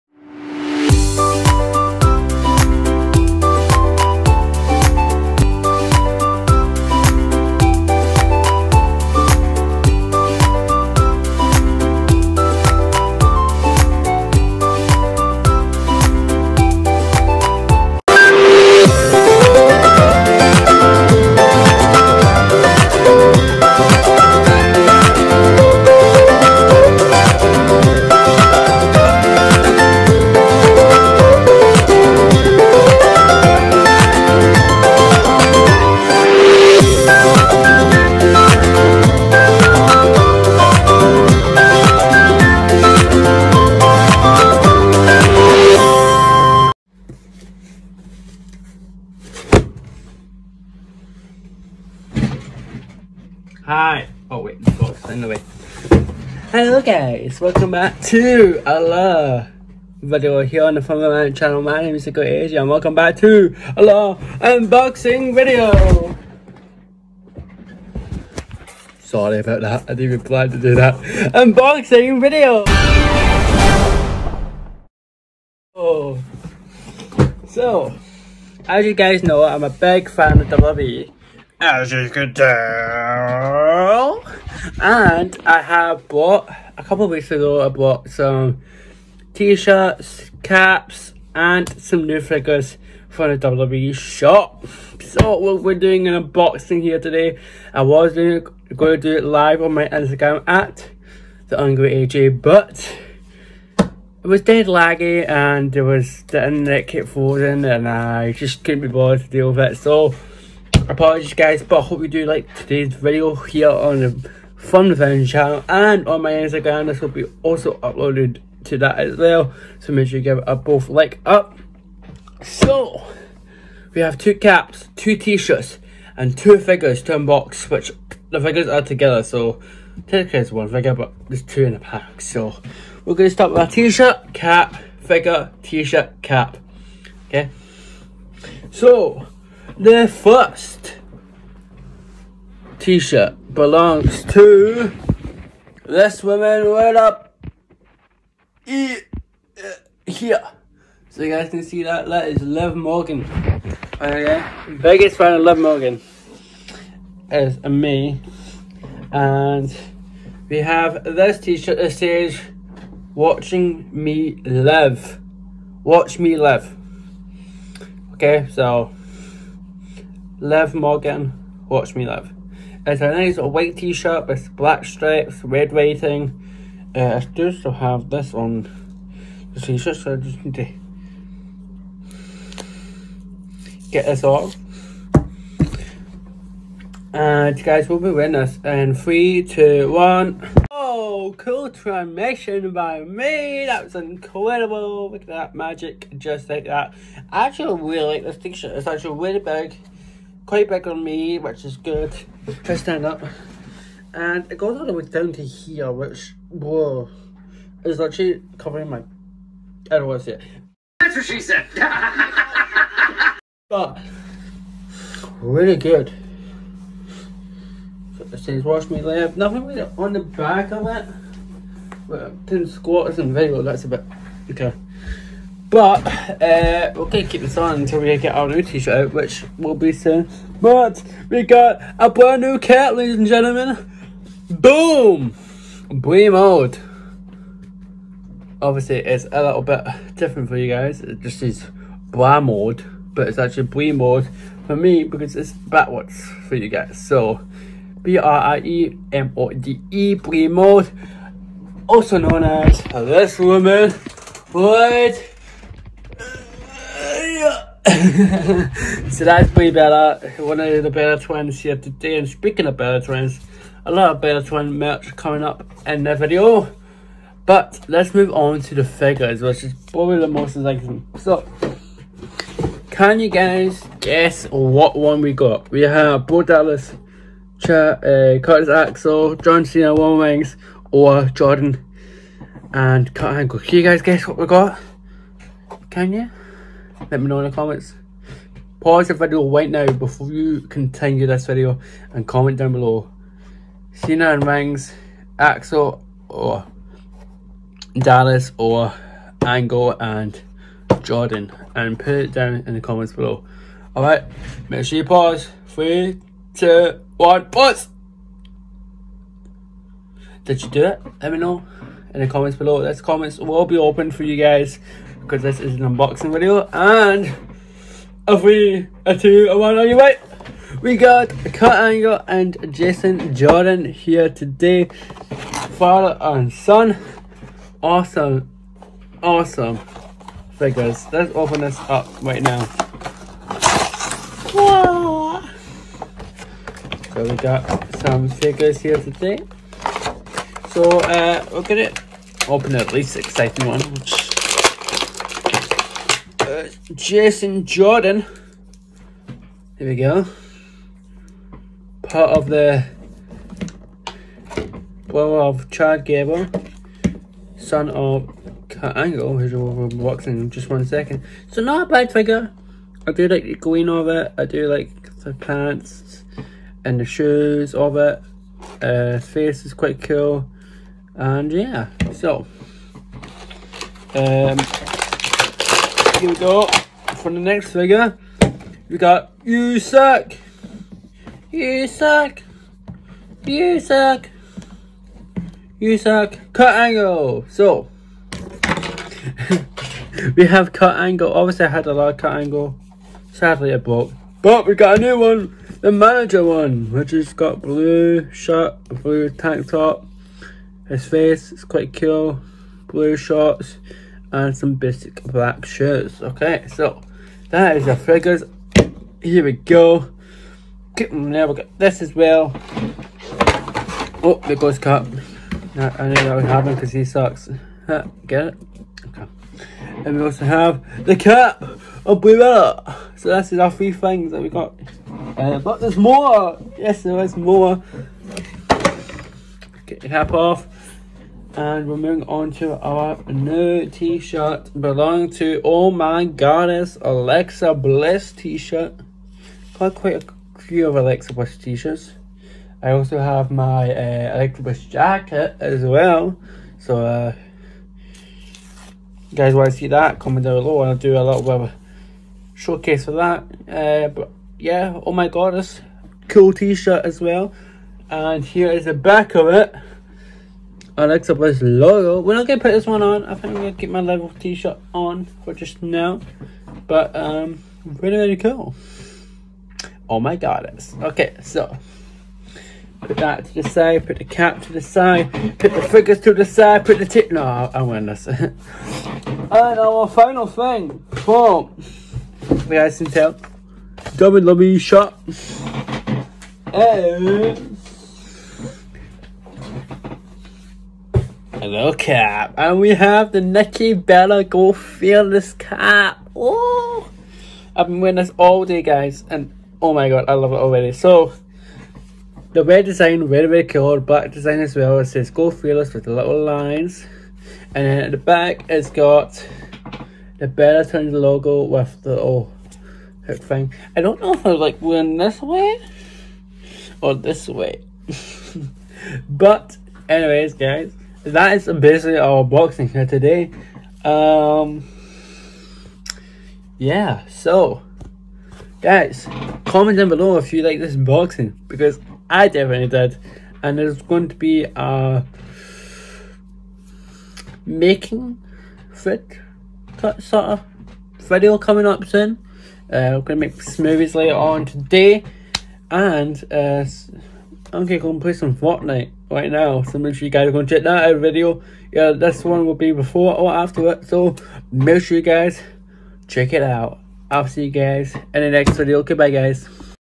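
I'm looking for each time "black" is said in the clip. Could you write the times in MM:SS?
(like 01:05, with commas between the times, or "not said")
02:54, 06:45, 08:23.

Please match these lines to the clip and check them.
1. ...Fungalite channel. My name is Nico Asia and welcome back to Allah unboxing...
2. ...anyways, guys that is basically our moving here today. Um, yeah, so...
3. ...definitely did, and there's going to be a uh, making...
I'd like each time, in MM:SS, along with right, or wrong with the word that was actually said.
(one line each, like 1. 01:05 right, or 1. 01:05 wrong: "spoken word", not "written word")
1. 01:00 right
2. 08:40 wrong: "boxing", not "moving"
3. 08:52 right.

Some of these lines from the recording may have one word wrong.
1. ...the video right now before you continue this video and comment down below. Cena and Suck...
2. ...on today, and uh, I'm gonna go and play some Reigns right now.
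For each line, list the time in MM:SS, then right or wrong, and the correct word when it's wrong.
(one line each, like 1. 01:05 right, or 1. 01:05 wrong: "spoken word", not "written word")
1. 04:49 wrong: "Reigns", not "Suck"
2. 09:04 wrong: "Fortnite", not "Reigns".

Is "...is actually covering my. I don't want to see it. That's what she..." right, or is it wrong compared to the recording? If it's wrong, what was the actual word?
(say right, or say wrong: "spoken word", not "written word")
right.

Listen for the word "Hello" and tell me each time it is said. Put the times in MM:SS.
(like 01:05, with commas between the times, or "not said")
00:56, 08:11.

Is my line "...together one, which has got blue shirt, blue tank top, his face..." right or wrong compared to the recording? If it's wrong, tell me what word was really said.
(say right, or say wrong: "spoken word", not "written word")
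wrong: "manager", not "together".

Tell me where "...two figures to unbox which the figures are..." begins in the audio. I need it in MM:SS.
02:06.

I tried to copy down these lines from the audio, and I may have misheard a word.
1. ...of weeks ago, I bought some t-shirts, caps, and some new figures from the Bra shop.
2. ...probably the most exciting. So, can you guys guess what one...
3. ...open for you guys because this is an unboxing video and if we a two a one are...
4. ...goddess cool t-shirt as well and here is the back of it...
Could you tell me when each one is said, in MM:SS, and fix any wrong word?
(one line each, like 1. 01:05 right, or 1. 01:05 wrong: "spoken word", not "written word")
1. 01:27 wrong: "WWE", not "Bra"
2. 04:29 right
3. 05:13 right
4. 07:35 right.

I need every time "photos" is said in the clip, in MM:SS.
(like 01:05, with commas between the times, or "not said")
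not said.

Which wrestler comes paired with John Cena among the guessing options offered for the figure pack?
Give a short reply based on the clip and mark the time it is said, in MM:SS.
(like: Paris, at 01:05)
Roman Reigns, at 04:39.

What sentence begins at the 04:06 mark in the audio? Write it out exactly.
So, B R I E M O D E, Bree mode, also known as this woman, right so that's pretty better.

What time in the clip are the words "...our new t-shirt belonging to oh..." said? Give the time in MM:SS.
07:12.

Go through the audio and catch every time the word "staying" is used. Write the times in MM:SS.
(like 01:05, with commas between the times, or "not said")
not said.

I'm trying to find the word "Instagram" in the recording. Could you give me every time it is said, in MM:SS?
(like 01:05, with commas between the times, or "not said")
01:39, 01:56.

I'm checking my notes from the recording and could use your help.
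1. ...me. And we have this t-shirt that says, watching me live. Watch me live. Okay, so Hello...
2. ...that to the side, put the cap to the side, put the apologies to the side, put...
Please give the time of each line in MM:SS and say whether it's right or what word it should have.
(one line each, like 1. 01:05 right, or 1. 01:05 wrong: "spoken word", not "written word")
1. 02:37 wrong: "Liv", not "Hello"
2. 07:53 wrong: "figures", not "apologies".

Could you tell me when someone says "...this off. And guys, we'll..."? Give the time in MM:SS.
03:04.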